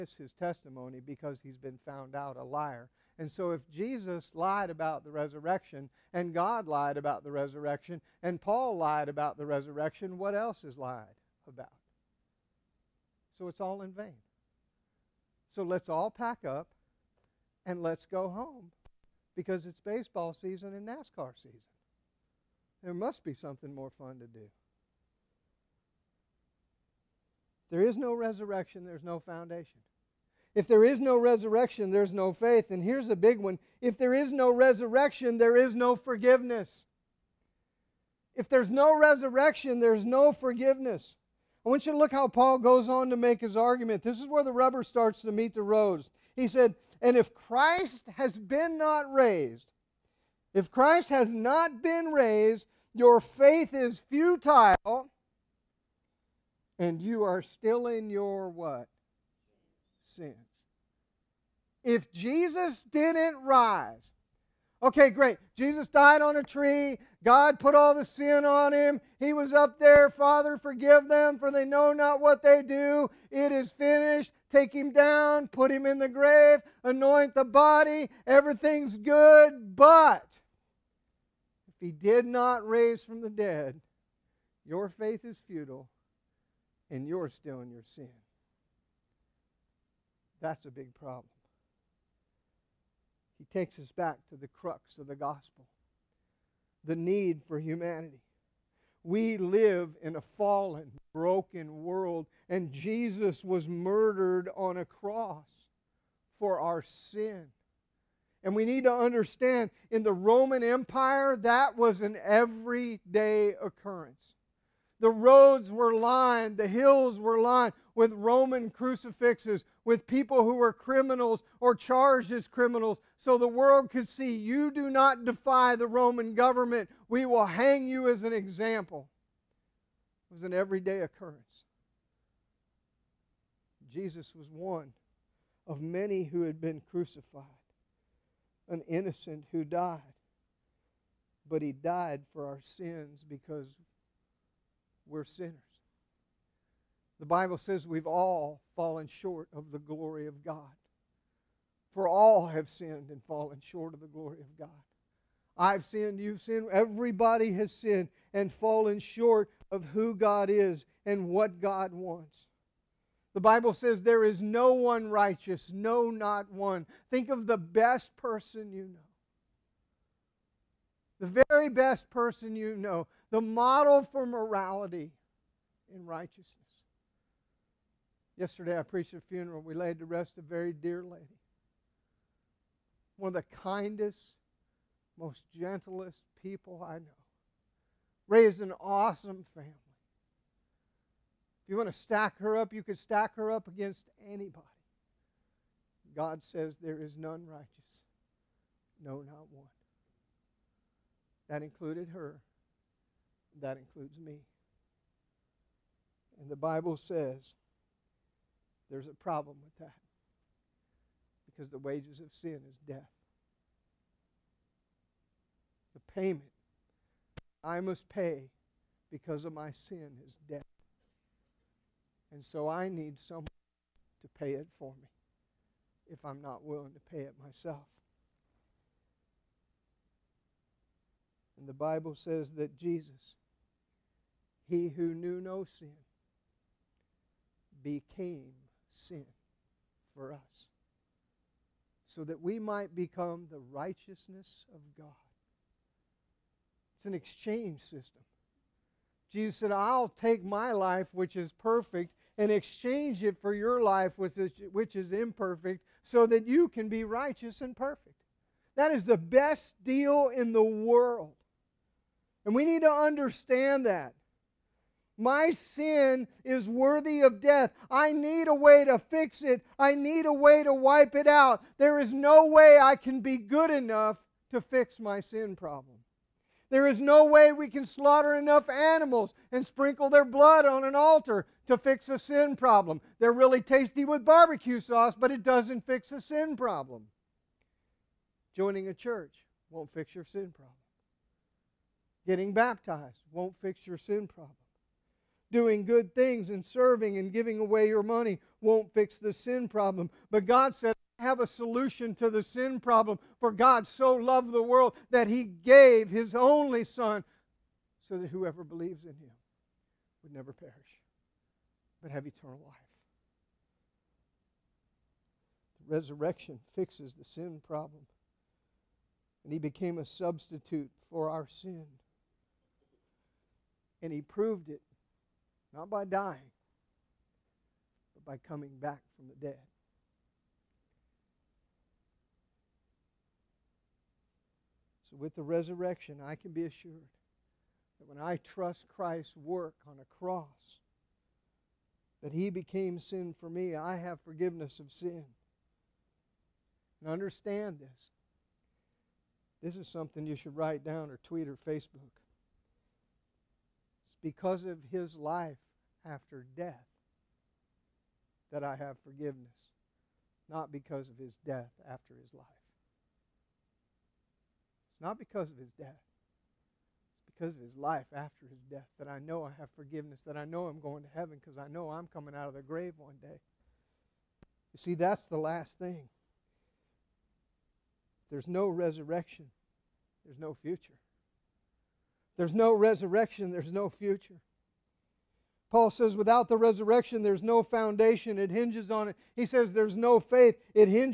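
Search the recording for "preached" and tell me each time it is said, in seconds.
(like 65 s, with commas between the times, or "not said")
178 s.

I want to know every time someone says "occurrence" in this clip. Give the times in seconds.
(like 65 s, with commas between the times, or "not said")
113 s, 131 s.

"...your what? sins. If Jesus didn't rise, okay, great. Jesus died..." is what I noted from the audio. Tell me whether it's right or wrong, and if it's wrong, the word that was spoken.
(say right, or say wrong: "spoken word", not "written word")
right.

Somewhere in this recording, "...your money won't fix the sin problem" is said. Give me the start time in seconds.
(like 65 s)
297 s.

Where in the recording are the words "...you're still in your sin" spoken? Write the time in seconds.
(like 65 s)
87 s.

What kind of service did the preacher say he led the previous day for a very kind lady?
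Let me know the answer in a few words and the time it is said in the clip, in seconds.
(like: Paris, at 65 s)
a funeral, at 179 s.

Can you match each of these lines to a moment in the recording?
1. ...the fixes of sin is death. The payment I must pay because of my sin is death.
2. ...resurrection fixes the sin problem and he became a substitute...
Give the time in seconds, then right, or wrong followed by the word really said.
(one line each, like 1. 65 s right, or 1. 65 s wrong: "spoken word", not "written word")
1. 211 s wrong: "wages", not "fixes"
2. 315 s right.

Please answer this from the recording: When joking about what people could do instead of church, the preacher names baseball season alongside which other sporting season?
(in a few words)
NASCAR.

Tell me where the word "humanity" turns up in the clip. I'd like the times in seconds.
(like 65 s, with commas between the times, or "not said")
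97 s.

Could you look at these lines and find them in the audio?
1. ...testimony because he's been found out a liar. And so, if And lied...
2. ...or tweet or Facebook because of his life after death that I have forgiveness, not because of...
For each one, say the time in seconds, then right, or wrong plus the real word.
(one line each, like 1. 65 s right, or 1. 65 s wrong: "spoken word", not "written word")
1. 0 s wrong: "Jesus", not "And"
2. 351 s right.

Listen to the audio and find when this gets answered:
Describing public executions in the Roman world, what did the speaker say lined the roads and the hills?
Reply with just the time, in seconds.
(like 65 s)
118 s.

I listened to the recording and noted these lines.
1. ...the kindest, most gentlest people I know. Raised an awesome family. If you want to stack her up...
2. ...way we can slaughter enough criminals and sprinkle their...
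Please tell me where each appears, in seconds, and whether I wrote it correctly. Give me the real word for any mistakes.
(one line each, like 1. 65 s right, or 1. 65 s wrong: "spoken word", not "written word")
1. 183 s right
2. 277 s wrong: "animals", not "criminals".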